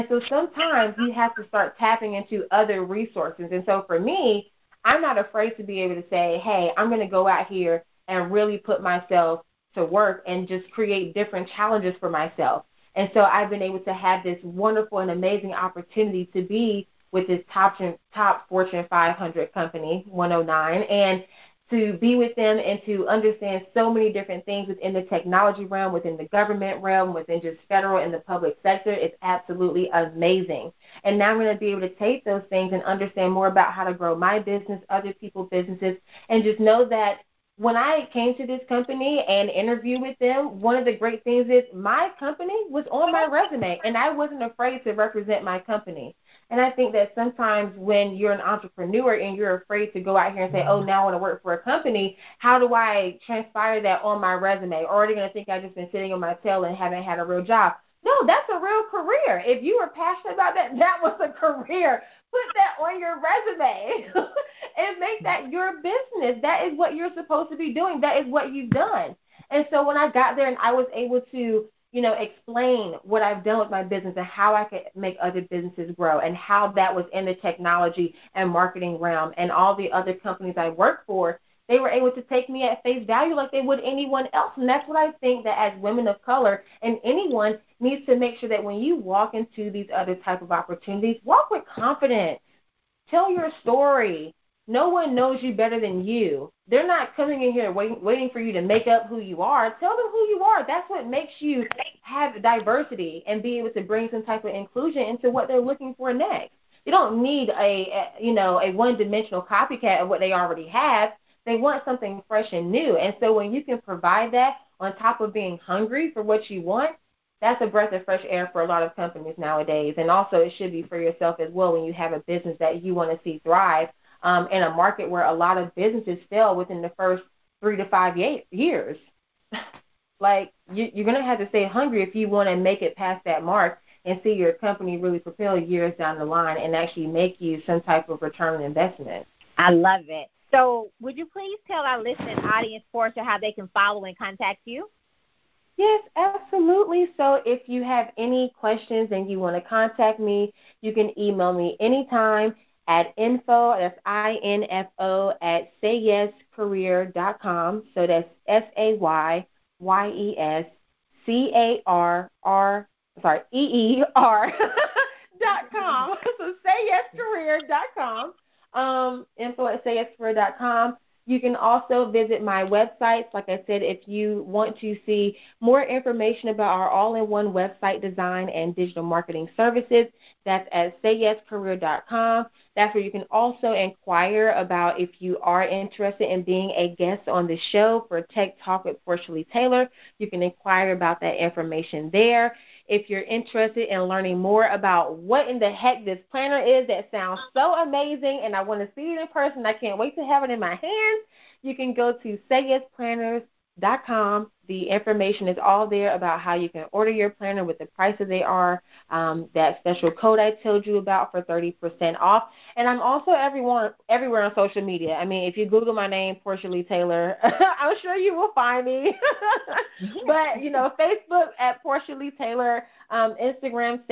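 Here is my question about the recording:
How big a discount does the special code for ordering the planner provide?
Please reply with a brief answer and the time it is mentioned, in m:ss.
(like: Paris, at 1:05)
30%, at 3:31.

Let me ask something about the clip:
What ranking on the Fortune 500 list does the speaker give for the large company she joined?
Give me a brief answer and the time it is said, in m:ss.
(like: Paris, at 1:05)
109, at 0:20.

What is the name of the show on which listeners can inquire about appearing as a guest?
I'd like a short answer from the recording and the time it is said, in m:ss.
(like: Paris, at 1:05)
Tech Talk with Porscha Lee Taylor, at 3:08.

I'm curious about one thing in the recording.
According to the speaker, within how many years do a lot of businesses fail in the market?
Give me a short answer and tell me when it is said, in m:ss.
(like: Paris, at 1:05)
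three to five years, at 2:07.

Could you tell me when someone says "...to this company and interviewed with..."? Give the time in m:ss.
0:38.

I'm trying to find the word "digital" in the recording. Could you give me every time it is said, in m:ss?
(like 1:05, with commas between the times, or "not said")
2:58.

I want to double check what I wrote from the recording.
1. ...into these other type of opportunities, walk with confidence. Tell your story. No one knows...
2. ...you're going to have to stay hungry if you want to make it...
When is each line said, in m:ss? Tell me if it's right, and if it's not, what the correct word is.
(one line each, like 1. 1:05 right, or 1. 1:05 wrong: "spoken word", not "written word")
1. 1:29 right
2. 2:10 right.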